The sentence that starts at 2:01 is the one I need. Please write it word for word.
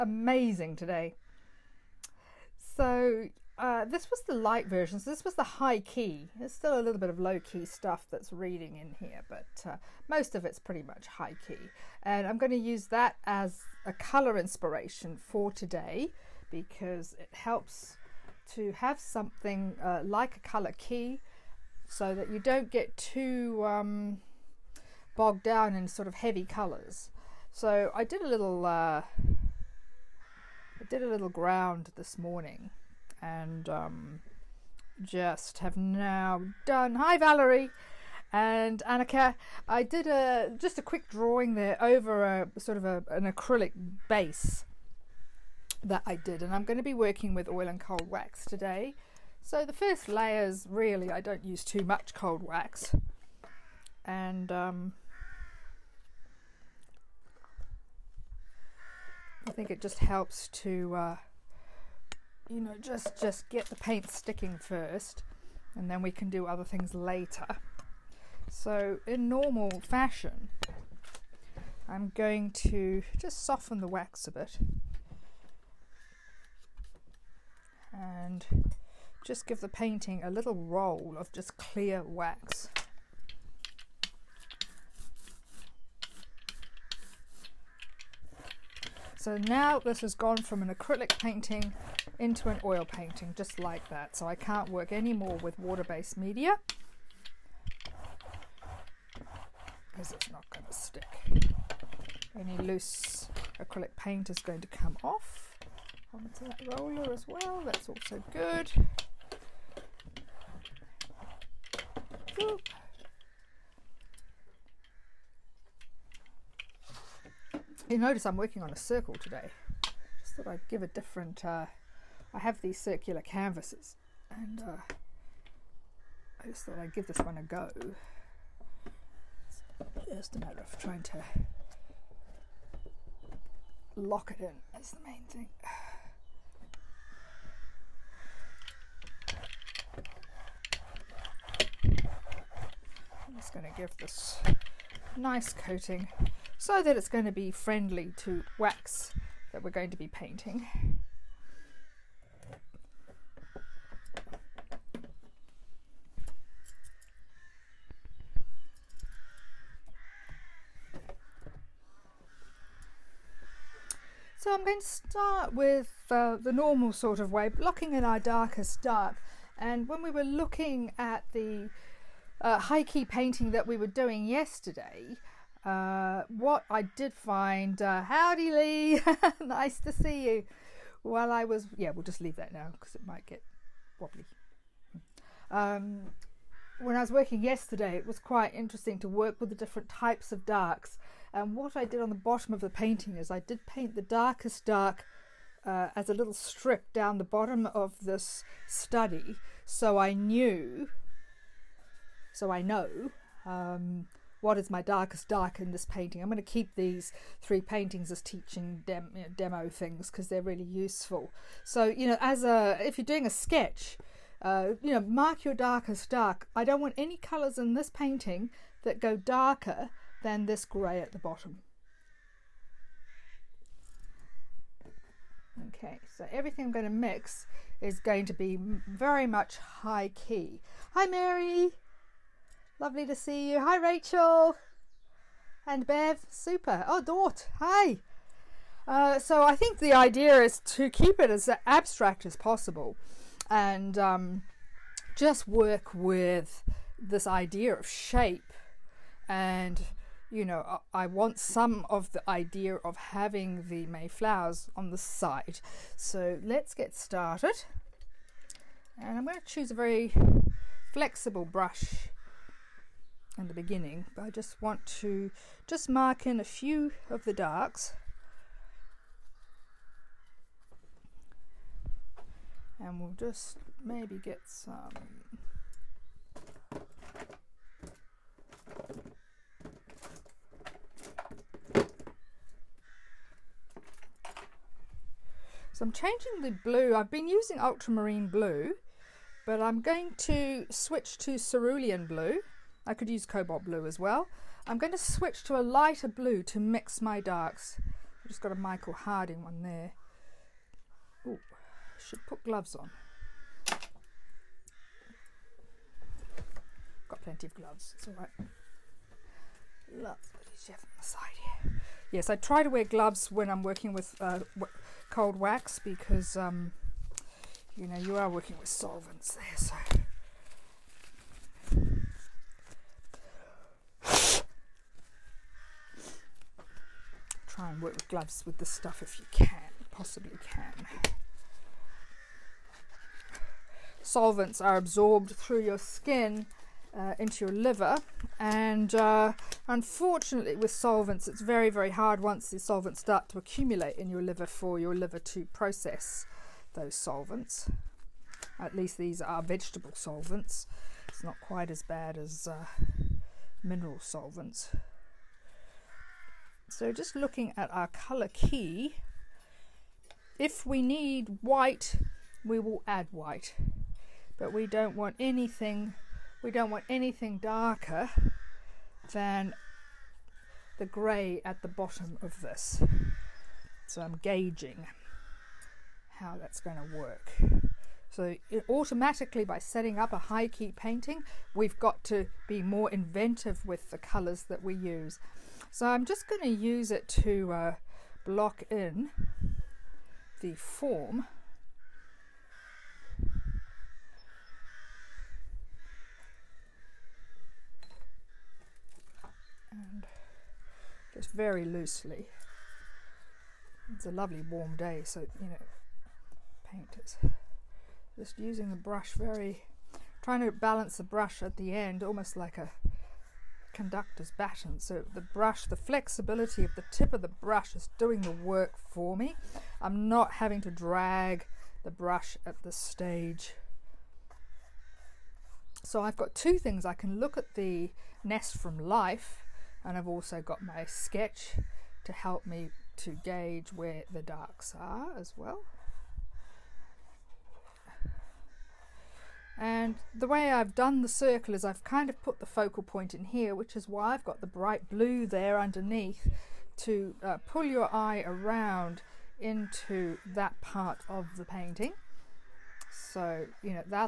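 Uh, I have these circular canvases, and uh, I just thought I'd give this one a go.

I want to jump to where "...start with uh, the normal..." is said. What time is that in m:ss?
2:44.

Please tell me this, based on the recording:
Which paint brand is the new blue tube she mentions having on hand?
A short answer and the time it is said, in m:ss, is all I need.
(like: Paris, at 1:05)
Michael Harding, at 4:58.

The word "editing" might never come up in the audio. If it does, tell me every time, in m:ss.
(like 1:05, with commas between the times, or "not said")
not said.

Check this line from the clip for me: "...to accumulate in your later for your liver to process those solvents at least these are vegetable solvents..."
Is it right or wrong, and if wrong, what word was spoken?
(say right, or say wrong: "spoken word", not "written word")
wrong: "liver", not "later".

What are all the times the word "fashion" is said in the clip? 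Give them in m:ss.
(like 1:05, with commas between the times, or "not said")
1:09.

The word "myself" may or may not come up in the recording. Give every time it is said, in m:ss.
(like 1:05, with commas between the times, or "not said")
not said.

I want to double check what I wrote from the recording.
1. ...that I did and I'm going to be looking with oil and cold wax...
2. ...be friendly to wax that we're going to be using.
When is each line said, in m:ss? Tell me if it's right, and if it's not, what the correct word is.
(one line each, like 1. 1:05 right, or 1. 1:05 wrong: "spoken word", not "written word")
1. 0:45 wrong: "working", not "looking"
2. 2:27 wrong: "painting", not "using".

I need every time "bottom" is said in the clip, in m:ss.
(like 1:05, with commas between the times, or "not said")
3:12, 3:17, 3:41, 6:11.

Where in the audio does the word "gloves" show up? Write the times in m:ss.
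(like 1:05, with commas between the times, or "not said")
5:02, 5:07, 5:12, 5:28.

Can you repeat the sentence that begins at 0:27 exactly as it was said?
So I did a little uh, I did a little ground this morning and um, just have now done.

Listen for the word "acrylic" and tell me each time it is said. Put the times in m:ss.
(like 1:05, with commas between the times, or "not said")
0:43, 1:30, 1:43.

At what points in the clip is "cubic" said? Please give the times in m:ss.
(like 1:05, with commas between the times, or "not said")
not said.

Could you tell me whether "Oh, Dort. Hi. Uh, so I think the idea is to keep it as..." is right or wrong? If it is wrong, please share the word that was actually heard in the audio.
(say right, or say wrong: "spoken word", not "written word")
right.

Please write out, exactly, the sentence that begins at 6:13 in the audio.
So I'm gauging how that's going to work.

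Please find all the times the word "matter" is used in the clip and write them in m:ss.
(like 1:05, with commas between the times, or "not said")
2:10.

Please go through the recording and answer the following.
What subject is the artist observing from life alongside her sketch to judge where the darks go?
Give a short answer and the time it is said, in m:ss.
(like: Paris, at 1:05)
The nest, at 7:08.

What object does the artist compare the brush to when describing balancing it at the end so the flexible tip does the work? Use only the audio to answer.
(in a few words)
A conductor's baton.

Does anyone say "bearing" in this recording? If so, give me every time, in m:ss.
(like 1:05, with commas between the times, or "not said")
not said.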